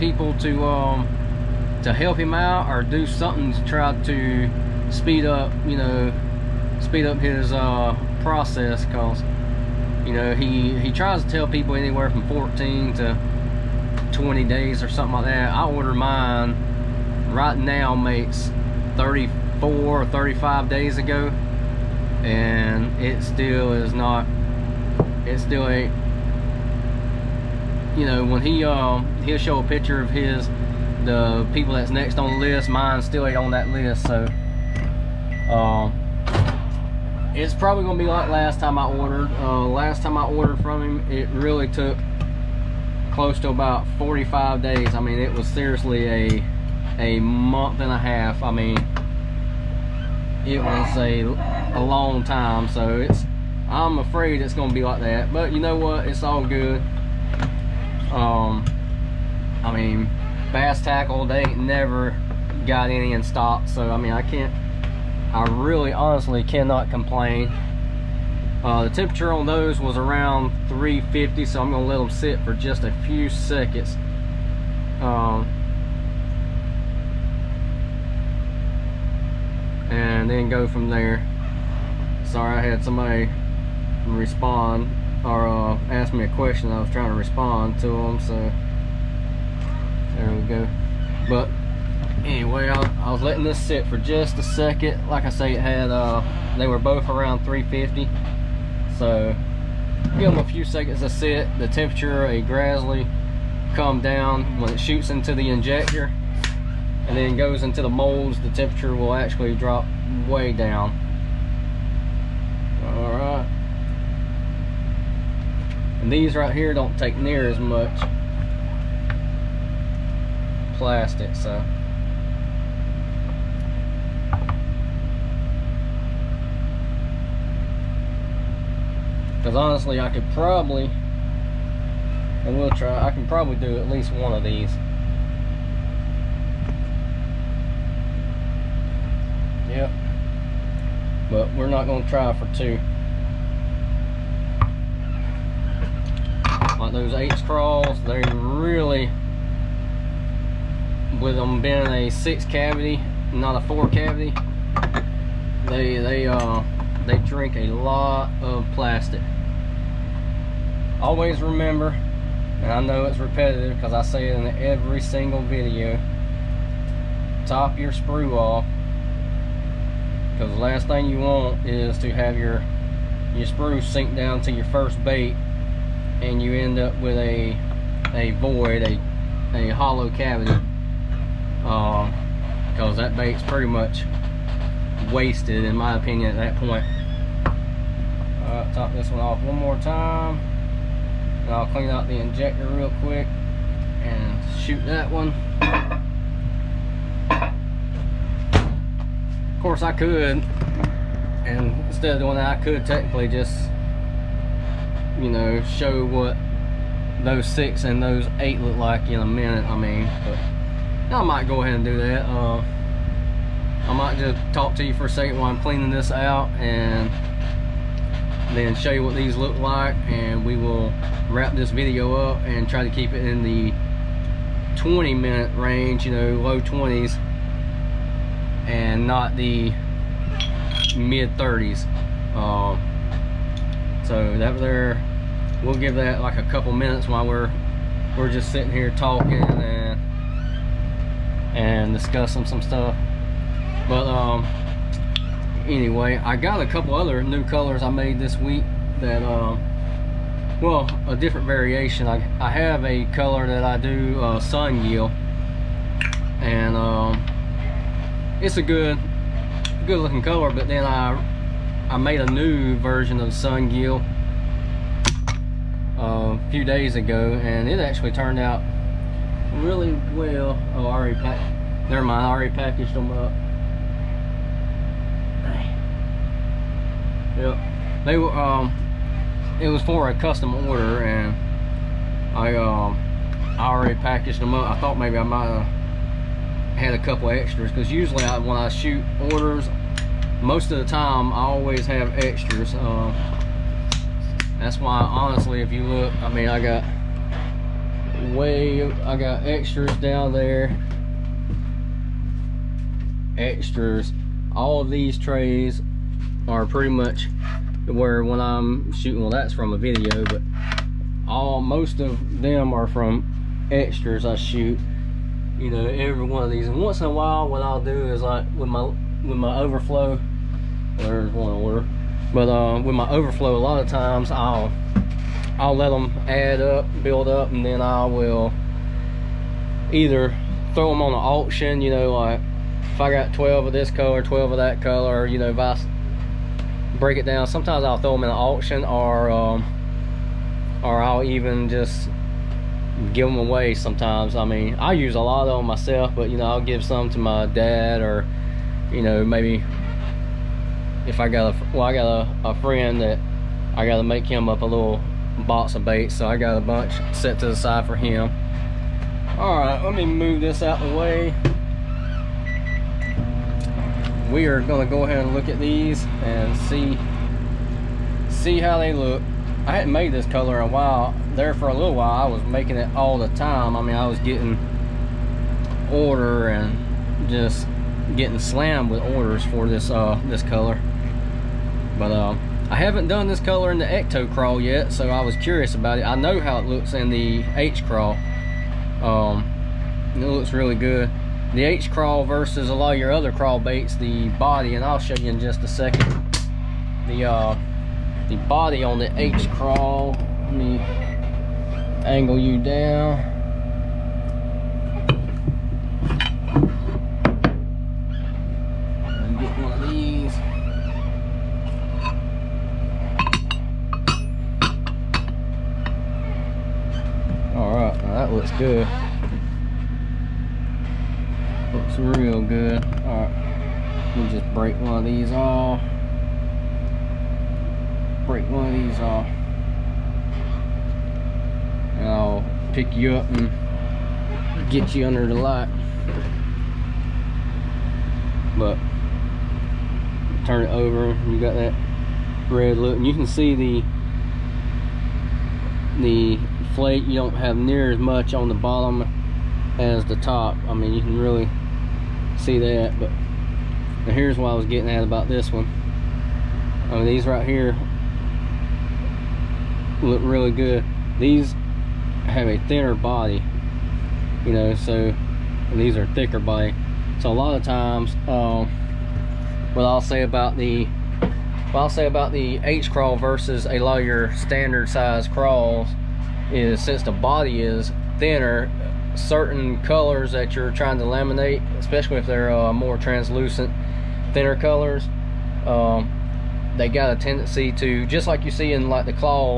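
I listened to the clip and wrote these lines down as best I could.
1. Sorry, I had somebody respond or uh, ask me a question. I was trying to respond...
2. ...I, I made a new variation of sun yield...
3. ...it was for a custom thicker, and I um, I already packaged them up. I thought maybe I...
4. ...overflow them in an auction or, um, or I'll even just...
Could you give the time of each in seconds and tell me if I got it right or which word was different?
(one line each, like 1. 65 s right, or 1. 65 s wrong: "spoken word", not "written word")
1. 82 s right
2. 260 s wrong: "version", not "variation"
3. 279 s wrong: "order", not "thicker"
4. 337 s wrong: "throw", not "overflow".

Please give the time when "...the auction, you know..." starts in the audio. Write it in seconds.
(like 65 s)
331 s.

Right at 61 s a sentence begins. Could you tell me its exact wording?
They ain't never got any in stock.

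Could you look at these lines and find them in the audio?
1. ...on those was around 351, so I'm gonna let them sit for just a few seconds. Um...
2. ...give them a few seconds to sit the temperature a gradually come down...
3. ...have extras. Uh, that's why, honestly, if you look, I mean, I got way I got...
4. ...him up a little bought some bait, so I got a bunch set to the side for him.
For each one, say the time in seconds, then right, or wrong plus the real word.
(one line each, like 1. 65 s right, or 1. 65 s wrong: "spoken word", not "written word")
1. 69 s wrong: "350", not "351"
2. 100 s right
3. 291 s right
4. 354 s right.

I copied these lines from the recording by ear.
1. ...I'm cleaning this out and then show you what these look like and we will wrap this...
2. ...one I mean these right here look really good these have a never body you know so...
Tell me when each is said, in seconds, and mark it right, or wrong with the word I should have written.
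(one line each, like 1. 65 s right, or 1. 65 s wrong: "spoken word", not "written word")
1. 215 s right
2. 455 s wrong: "thinner", not "never".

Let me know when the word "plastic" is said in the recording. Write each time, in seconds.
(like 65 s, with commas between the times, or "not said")
120 s, 158 s.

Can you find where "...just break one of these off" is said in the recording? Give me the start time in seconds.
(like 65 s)
424 s.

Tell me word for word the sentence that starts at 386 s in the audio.
I know how it looks in the H craw.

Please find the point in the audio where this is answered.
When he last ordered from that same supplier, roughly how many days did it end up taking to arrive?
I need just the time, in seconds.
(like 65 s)
43 s.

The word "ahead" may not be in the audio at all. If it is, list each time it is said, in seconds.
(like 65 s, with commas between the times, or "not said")
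211 s, 365 s.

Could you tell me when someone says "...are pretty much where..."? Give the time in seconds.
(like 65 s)
306 s.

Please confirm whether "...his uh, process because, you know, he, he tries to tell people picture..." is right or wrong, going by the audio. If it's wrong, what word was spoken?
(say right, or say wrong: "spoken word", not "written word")
wrong: "anywhere", not "picture".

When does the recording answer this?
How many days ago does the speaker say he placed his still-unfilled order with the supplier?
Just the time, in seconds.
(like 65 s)
18 s.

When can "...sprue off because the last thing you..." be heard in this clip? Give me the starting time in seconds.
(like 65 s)
167 s.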